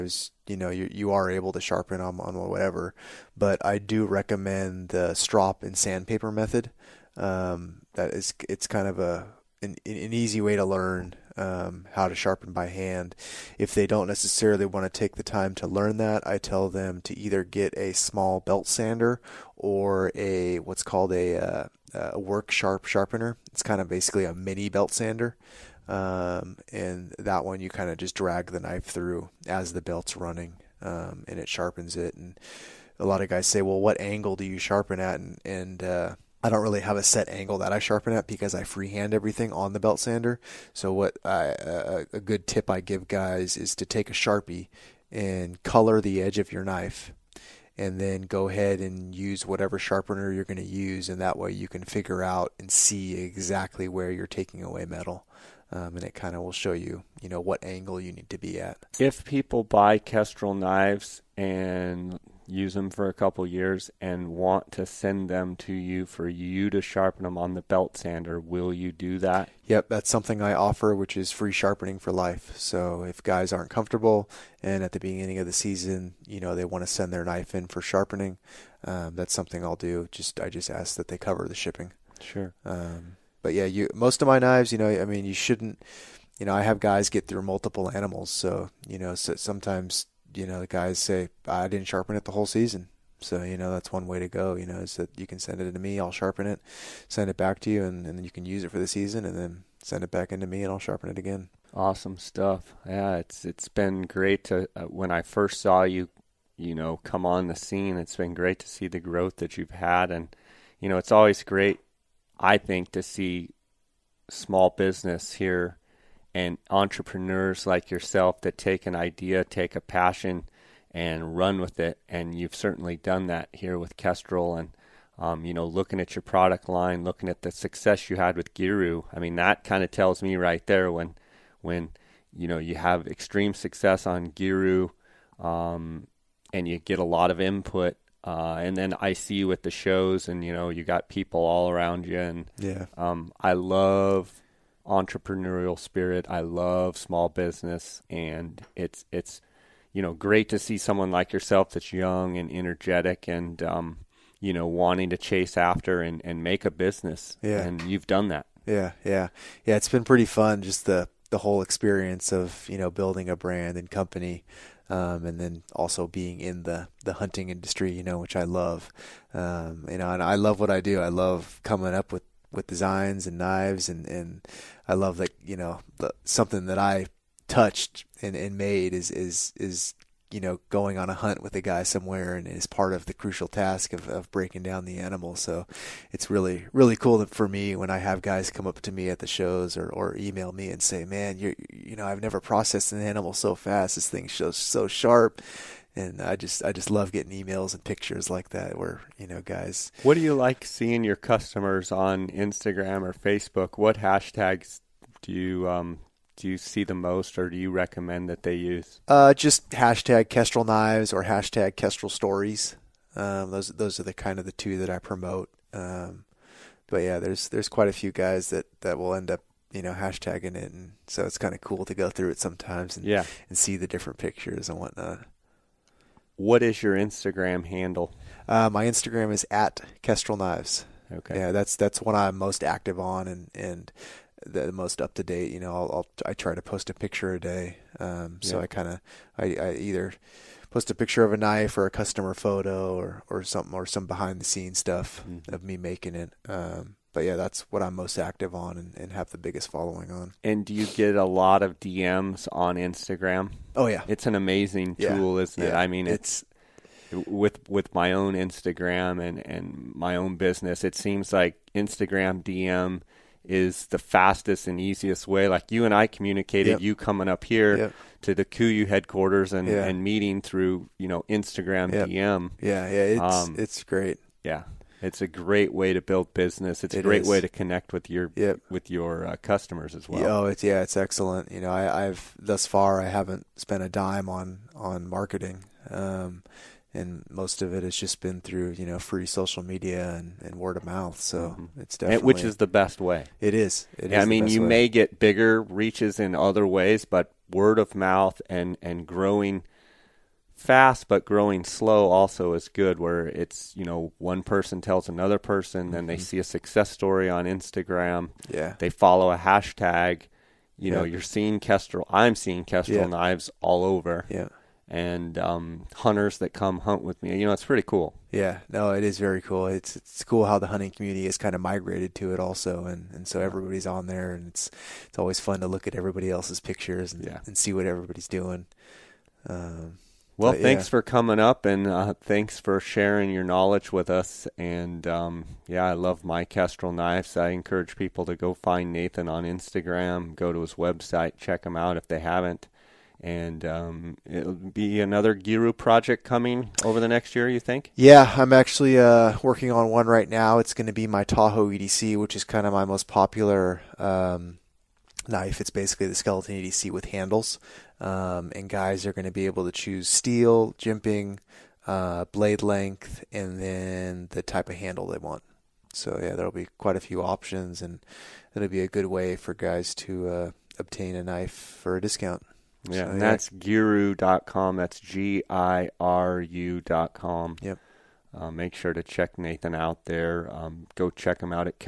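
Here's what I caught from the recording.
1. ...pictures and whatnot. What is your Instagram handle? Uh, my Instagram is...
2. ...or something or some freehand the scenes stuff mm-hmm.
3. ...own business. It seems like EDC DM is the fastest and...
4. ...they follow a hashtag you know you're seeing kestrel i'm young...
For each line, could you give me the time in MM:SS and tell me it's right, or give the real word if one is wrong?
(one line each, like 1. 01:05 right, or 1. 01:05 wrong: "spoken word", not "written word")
1. 03:44 right
2. 04:03 wrong: "behind", not "freehand"
3. 04:20 wrong: "Instagram", not "EDC"
4. 05:08 wrong: "seeing", not "young".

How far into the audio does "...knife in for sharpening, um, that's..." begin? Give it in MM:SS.
01:17.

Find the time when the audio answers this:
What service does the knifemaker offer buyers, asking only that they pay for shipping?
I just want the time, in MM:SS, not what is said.
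01:11.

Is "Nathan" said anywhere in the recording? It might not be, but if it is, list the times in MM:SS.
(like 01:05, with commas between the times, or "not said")
05:38, 06:19.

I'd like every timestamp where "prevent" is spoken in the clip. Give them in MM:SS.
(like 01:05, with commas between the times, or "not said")
not said.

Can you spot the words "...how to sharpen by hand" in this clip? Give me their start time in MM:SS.
00:11.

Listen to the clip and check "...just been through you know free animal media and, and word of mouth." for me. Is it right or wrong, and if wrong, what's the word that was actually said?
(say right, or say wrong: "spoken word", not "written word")
wrong: "social", not "animal".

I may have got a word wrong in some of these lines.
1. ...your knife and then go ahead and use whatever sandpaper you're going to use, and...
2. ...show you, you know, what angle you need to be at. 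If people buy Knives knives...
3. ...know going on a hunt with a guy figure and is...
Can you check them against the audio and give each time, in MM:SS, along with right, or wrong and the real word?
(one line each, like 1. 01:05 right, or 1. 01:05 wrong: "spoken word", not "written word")
1. 00:46 wrong: "sharpener", not "sandpaper"
2. 00:56 wrong: "Kestrel", not "Knives"
3. 03:00 wrong: "somewhere", not "figure".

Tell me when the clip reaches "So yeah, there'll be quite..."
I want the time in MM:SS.
06:05.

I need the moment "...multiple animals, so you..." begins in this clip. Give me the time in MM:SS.
01:27.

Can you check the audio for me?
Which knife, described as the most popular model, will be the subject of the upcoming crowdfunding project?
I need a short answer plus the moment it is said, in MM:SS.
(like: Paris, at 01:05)
Tahoe EDC, at 05:51.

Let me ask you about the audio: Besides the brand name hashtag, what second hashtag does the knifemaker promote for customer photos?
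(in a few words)
Kestrel stories.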